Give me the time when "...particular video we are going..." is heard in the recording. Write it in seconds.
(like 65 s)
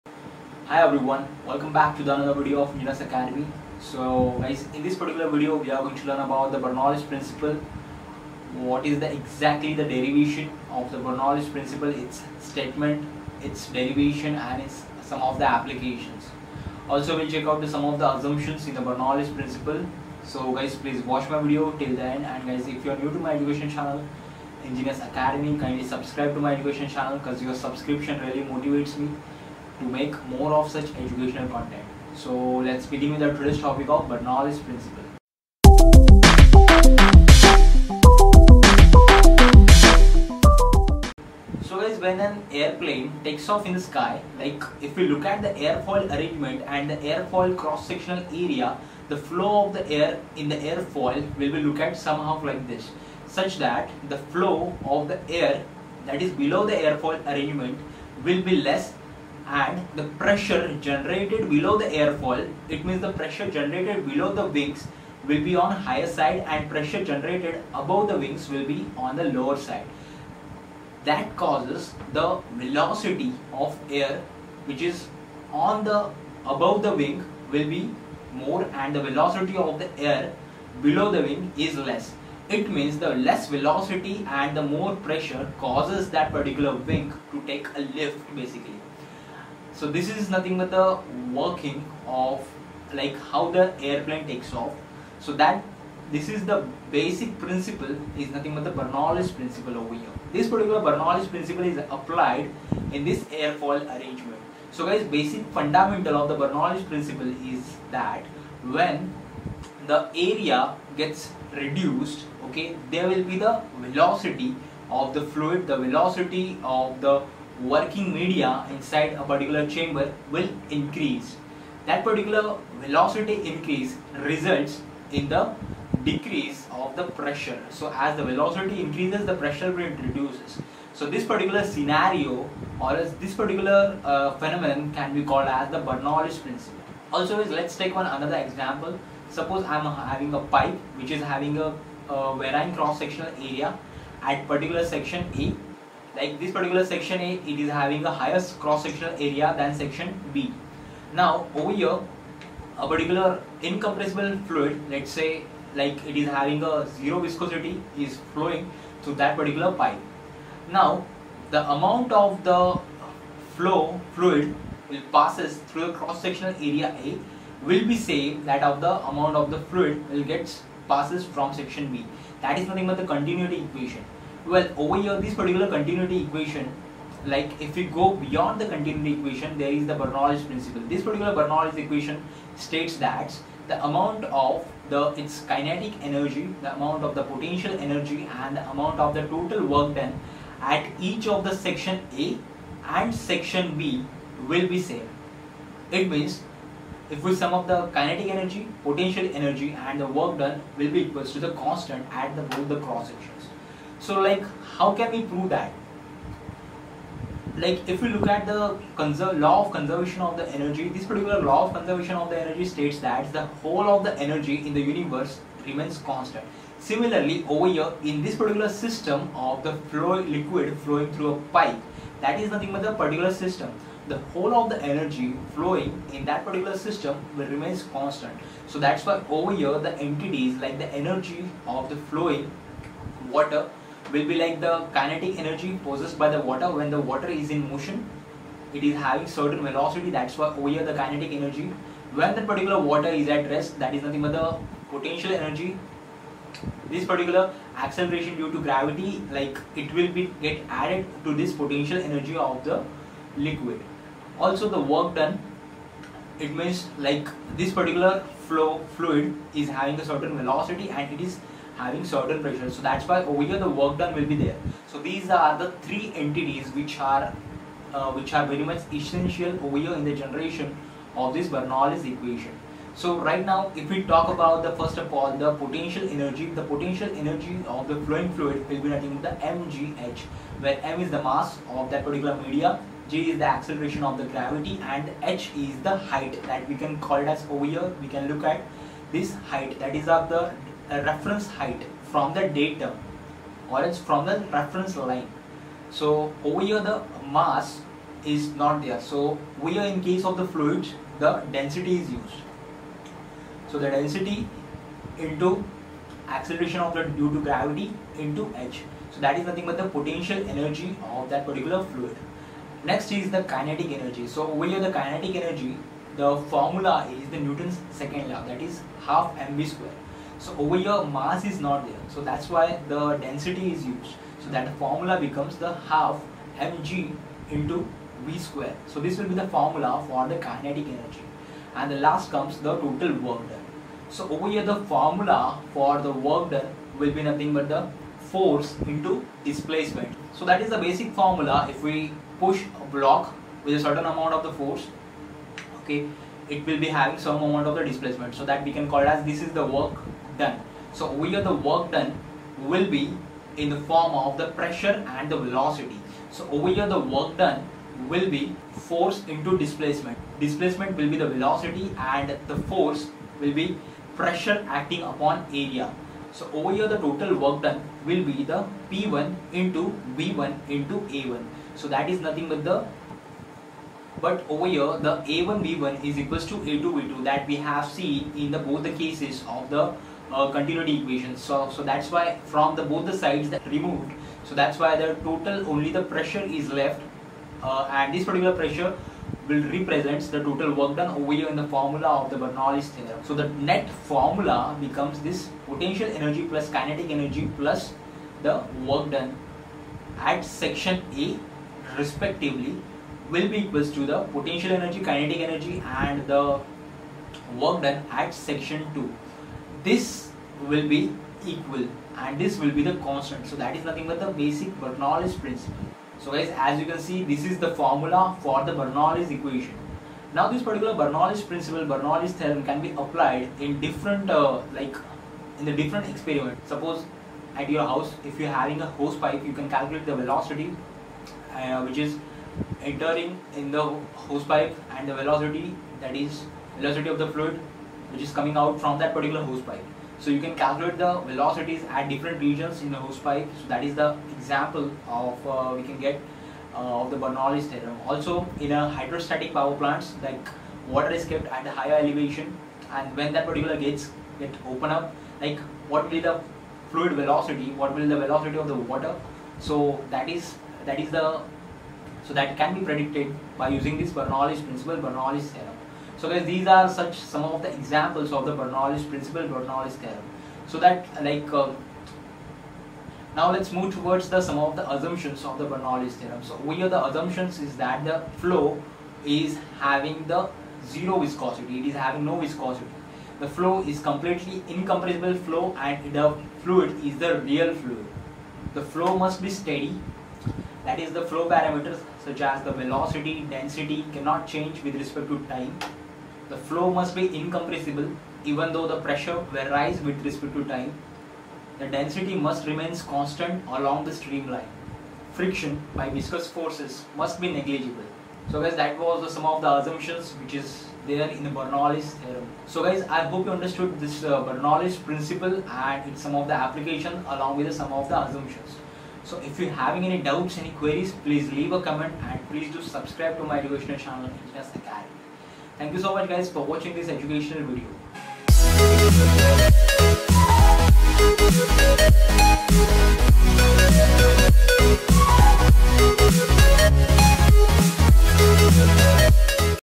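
4 s.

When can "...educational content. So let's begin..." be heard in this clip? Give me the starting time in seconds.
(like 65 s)
31 s.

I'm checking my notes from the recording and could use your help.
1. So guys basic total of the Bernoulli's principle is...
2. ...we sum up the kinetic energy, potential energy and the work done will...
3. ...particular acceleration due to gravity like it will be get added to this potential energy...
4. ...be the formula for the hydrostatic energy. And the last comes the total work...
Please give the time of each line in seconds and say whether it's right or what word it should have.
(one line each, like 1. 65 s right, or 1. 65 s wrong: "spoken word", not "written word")
1. 104 s wrong: "fundamental", not "total"
2. 197 s right
3. 247 s right
4. 329 s wrong: "kinetic", not "hydrostatic".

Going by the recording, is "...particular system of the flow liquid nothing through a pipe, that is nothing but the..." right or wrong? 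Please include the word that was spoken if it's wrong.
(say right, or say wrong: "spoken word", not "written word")
wrong: "flowing", not "nothing".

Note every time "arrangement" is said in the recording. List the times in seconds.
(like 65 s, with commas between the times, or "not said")
46 s, 57 s, 103 s.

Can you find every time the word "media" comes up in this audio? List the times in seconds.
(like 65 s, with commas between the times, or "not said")
118 s, 282 s.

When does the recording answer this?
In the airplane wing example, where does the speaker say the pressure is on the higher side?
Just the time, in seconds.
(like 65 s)
64 s.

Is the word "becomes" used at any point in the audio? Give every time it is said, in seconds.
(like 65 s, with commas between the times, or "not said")
325 s, 394 s.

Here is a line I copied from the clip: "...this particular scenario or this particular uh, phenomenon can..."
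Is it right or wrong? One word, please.
right.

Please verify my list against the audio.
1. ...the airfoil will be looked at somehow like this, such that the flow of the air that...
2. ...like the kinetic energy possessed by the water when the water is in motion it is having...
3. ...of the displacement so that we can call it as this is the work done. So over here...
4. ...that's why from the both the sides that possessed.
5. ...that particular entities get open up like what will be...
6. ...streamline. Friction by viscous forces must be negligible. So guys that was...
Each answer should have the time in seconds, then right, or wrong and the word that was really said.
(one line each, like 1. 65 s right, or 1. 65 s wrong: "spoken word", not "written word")
1. 50 s right
2. 234 s right
3. 347 s right
4. 381 s wrong: "removed", not "possessed"
5. 453 s wrong: "gates", not "entities"
6. 504 s right.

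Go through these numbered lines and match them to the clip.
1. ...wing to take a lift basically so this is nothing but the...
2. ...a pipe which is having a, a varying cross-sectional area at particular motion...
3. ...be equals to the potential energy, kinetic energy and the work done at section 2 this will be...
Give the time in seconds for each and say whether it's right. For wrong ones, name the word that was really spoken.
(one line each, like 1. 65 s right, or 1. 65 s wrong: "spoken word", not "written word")
1. 86 s right
2. 140 s wrong: "section", not "motion"
3. 403 s right.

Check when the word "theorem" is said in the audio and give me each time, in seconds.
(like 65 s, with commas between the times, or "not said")
392 s, 422 s, 447 s, 465 s, 469 s, 476 s, 512 s.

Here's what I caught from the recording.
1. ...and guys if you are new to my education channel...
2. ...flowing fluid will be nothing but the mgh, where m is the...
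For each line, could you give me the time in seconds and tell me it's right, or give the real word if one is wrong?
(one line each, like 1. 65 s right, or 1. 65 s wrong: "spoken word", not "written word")
1. 22 s right
2. 278 s right.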